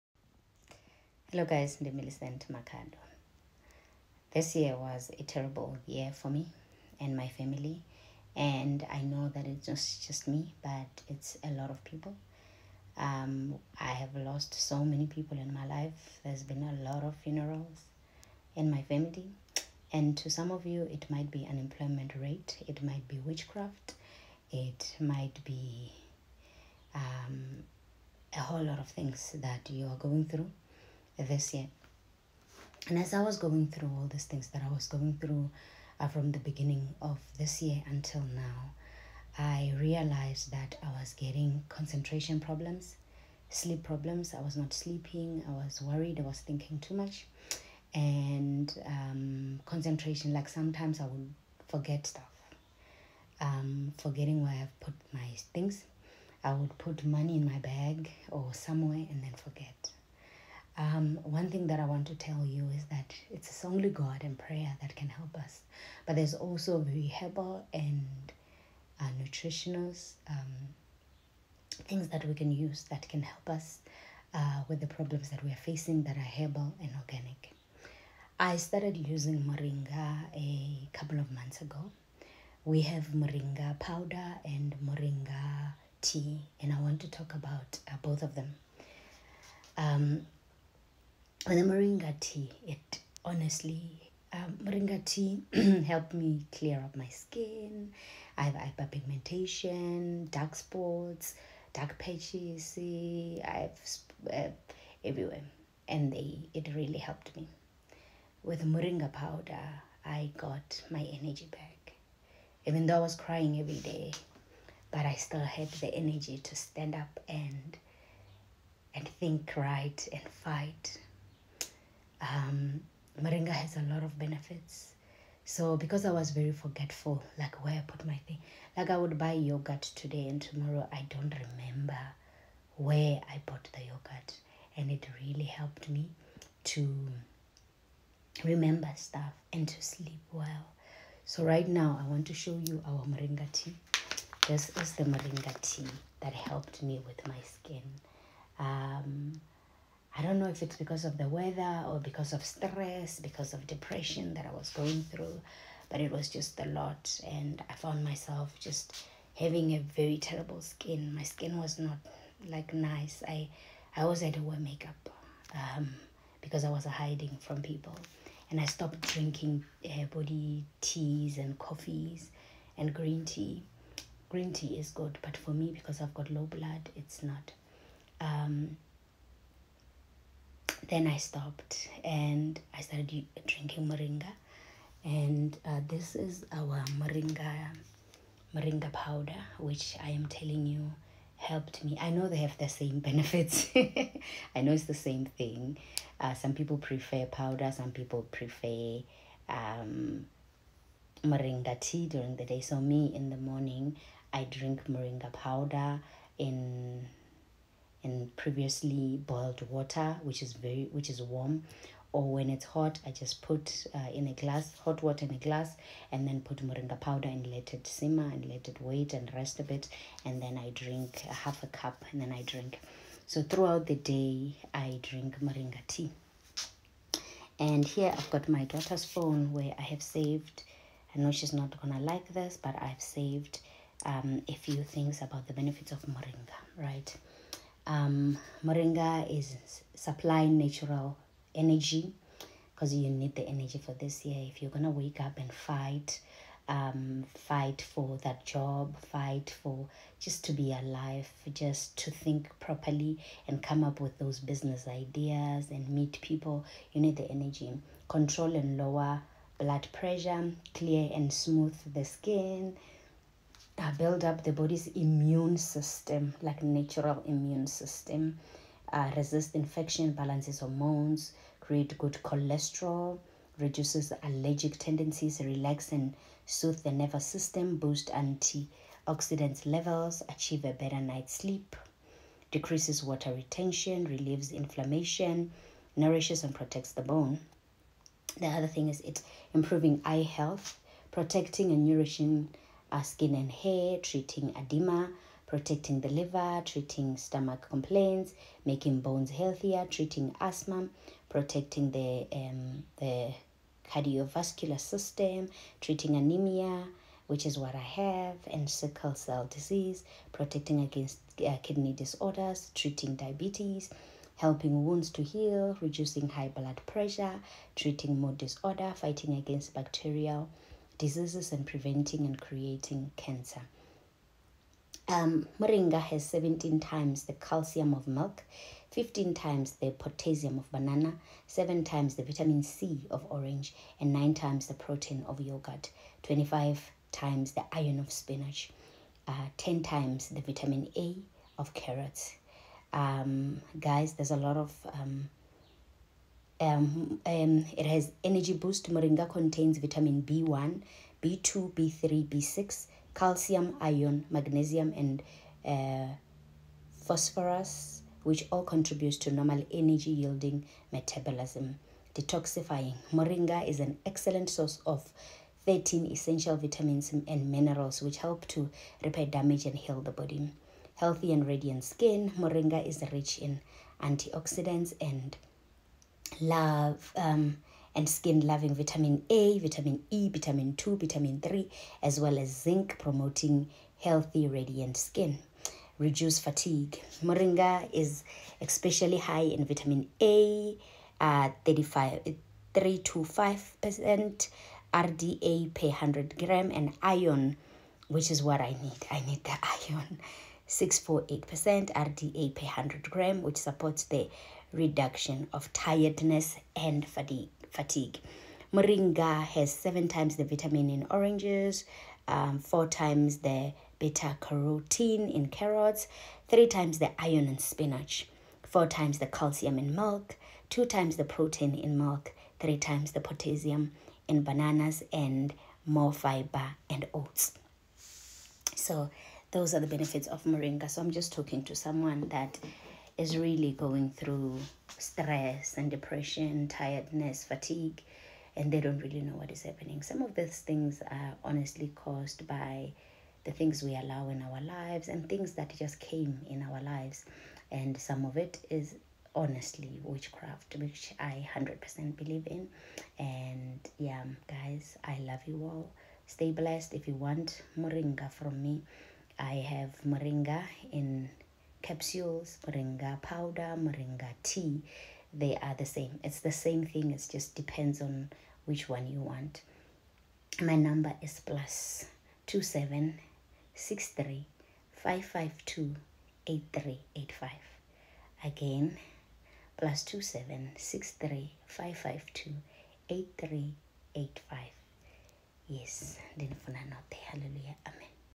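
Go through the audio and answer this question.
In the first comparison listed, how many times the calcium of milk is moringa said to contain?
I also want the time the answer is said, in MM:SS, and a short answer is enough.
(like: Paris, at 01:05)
17 times, at 05:26.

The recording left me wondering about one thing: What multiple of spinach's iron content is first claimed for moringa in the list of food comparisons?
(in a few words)
25 times.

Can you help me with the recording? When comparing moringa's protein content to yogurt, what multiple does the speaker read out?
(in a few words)
9 times.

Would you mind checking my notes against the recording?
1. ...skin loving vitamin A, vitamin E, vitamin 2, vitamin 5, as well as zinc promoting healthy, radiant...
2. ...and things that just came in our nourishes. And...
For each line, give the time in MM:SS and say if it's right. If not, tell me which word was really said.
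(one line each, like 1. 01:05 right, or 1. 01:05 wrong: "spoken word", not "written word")
1. 06:18 wrong: "3", not "5"
2. 07:25 wrong: "lives", not "nourishes".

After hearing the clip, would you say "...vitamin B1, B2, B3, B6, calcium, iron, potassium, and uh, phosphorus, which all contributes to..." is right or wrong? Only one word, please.
wrong.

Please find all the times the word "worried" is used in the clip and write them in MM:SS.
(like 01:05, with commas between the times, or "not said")
00:45.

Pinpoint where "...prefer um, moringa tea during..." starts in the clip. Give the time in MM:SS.
03:18.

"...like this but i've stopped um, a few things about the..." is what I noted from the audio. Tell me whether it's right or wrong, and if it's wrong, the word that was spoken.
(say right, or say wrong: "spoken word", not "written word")
wrong: "saved", not "stopped".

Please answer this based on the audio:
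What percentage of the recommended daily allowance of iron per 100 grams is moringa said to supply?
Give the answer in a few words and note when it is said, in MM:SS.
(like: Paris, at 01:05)
648%, at 06:40.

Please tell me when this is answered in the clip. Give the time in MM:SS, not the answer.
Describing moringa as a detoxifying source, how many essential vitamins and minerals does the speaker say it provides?
06:05.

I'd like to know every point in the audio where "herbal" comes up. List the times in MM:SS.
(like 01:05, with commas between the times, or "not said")
01:07, 01:16.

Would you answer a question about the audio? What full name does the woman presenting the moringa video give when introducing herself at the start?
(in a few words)
Millicent Makhado.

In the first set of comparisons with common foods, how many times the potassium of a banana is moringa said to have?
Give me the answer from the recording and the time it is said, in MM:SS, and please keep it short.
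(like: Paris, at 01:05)
15 times, at 05:28.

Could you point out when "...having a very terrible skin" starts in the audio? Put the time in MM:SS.
02:39.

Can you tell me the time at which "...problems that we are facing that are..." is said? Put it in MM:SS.
01:14.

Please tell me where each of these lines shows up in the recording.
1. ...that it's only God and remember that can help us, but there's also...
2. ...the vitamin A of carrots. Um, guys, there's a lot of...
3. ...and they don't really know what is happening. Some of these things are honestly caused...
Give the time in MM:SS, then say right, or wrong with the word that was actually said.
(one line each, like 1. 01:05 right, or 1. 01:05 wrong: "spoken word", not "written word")
1. 01:02 wrong: "prayer", not "remember"
2. 05:40 right
3. 07:18 right.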